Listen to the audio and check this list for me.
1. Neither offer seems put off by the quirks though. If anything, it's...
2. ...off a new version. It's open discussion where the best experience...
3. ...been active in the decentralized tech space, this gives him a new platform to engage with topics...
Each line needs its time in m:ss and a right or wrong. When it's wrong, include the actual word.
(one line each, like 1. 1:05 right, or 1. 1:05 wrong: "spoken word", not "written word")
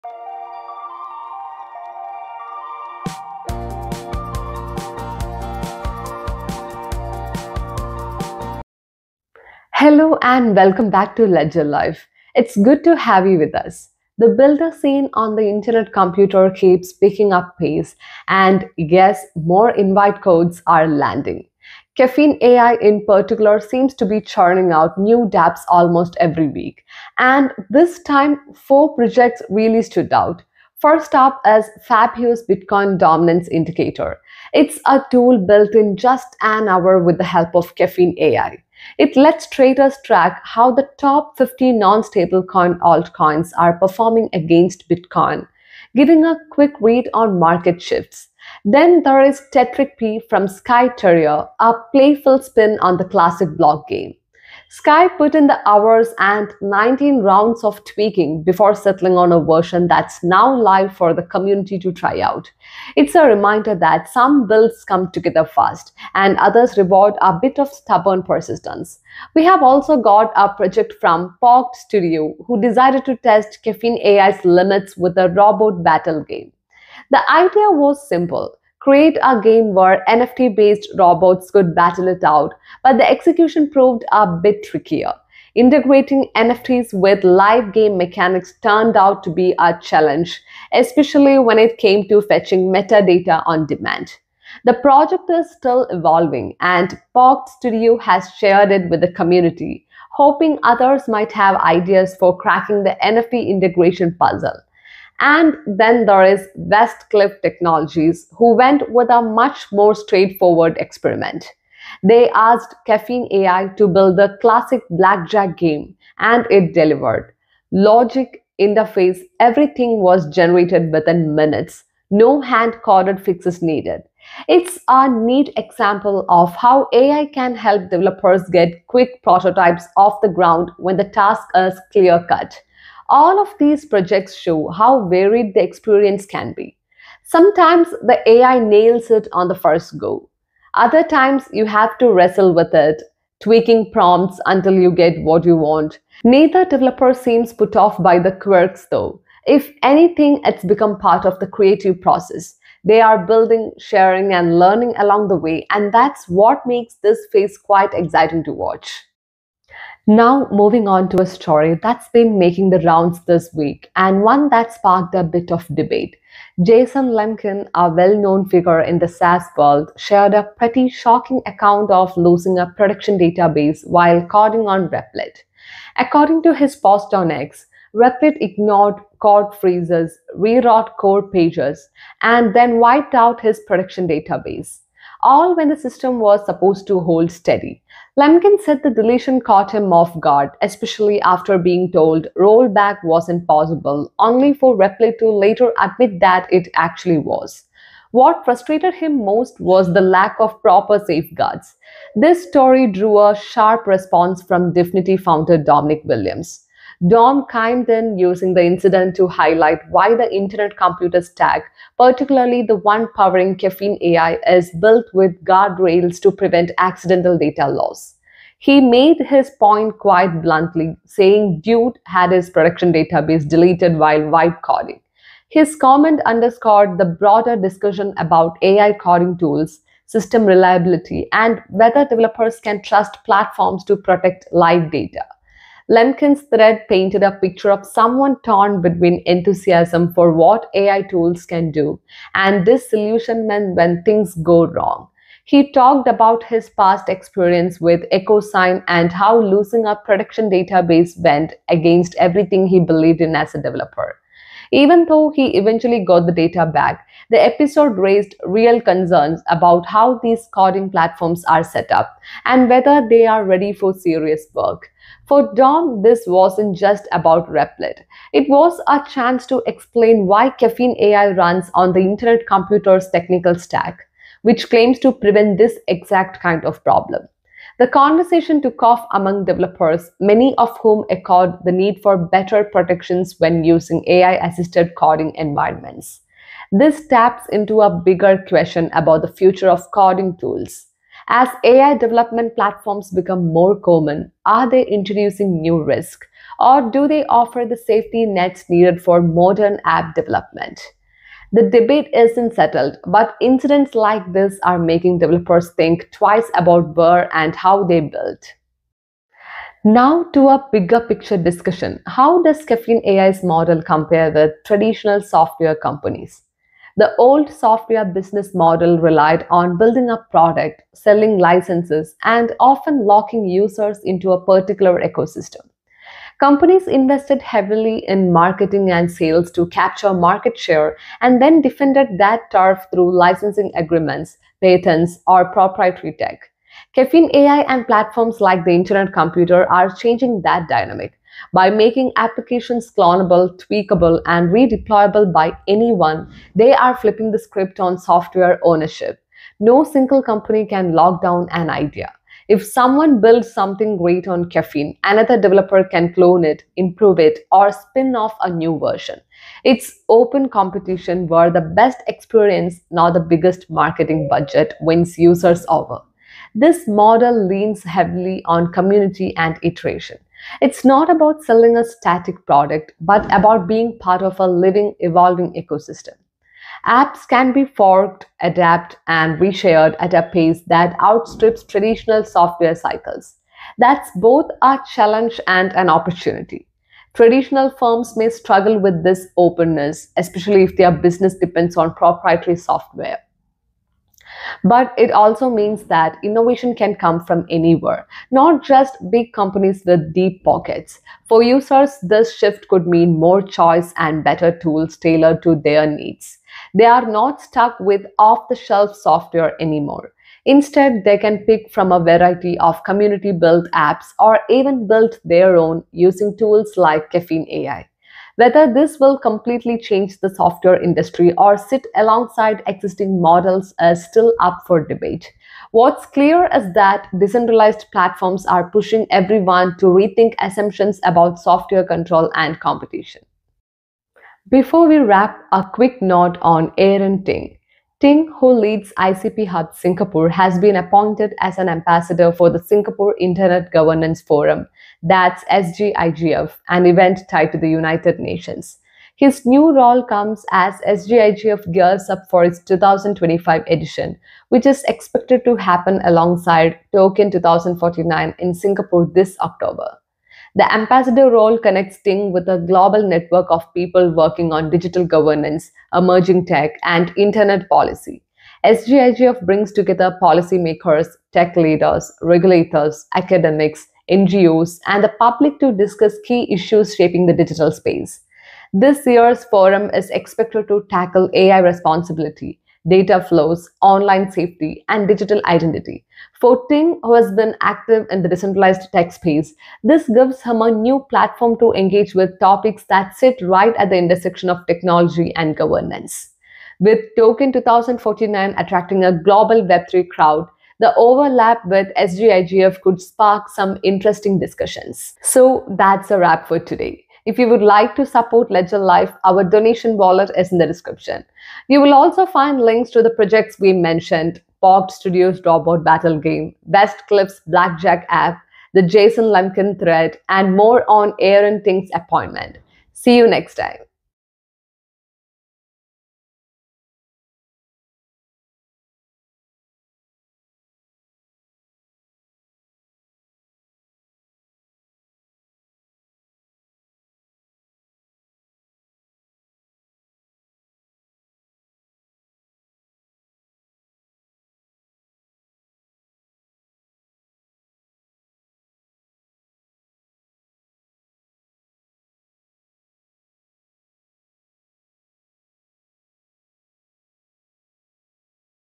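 1. 2:26 wrong: "developer", not "offer"
2. 5:58 wrong: "competition", not "discussion"
3. 8:07 right.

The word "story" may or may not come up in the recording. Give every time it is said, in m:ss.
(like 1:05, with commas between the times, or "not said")
2:41, 3:22.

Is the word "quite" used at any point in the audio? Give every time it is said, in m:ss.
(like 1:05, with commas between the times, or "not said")
2:37, 3:39.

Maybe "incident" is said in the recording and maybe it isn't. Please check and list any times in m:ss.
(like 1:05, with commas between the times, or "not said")
3:28, 5:03.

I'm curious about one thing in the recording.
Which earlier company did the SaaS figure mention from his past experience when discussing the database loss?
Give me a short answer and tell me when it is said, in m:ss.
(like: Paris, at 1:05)
EchoSign, at 4:08.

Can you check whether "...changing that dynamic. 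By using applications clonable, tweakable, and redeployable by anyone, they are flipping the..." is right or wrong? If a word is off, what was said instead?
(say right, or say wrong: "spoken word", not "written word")
wrong: "making", not "using".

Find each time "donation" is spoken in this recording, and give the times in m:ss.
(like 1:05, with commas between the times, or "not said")
8:29.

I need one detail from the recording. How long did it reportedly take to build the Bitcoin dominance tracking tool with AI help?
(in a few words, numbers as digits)
an hour.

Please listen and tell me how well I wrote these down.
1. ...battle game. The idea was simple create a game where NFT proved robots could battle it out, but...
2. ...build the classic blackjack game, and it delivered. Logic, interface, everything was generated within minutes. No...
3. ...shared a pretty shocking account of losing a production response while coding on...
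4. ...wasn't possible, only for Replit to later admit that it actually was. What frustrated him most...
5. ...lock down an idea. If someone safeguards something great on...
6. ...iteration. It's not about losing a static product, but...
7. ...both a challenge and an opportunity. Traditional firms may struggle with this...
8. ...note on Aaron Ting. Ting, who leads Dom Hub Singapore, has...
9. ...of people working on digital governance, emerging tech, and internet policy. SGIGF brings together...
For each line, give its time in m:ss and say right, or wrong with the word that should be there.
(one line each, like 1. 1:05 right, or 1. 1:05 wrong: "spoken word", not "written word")
1. 1:15 wrong: "based", not "proved"
2. 1:53 right
3. 2:49 wrong: "database", not "response"
4. 3:13 right
5. 5:50 wrong: "builds", not "safeguards"
6. 6:09 wrong: "selling", not "losing"
7. 6:24 right
8. 7:16 wrong: "ICP", not "Dom"
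9. 7:43 right.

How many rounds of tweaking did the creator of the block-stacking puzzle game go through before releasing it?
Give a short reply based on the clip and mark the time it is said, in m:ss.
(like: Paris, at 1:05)
19, at 0:56.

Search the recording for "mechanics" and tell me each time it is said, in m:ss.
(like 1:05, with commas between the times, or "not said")
1:27.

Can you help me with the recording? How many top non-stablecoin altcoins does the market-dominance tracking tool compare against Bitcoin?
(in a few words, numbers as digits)
50.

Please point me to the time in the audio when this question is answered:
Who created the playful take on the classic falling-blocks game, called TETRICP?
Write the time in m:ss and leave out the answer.
0:50.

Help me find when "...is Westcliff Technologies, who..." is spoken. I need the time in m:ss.
1:46.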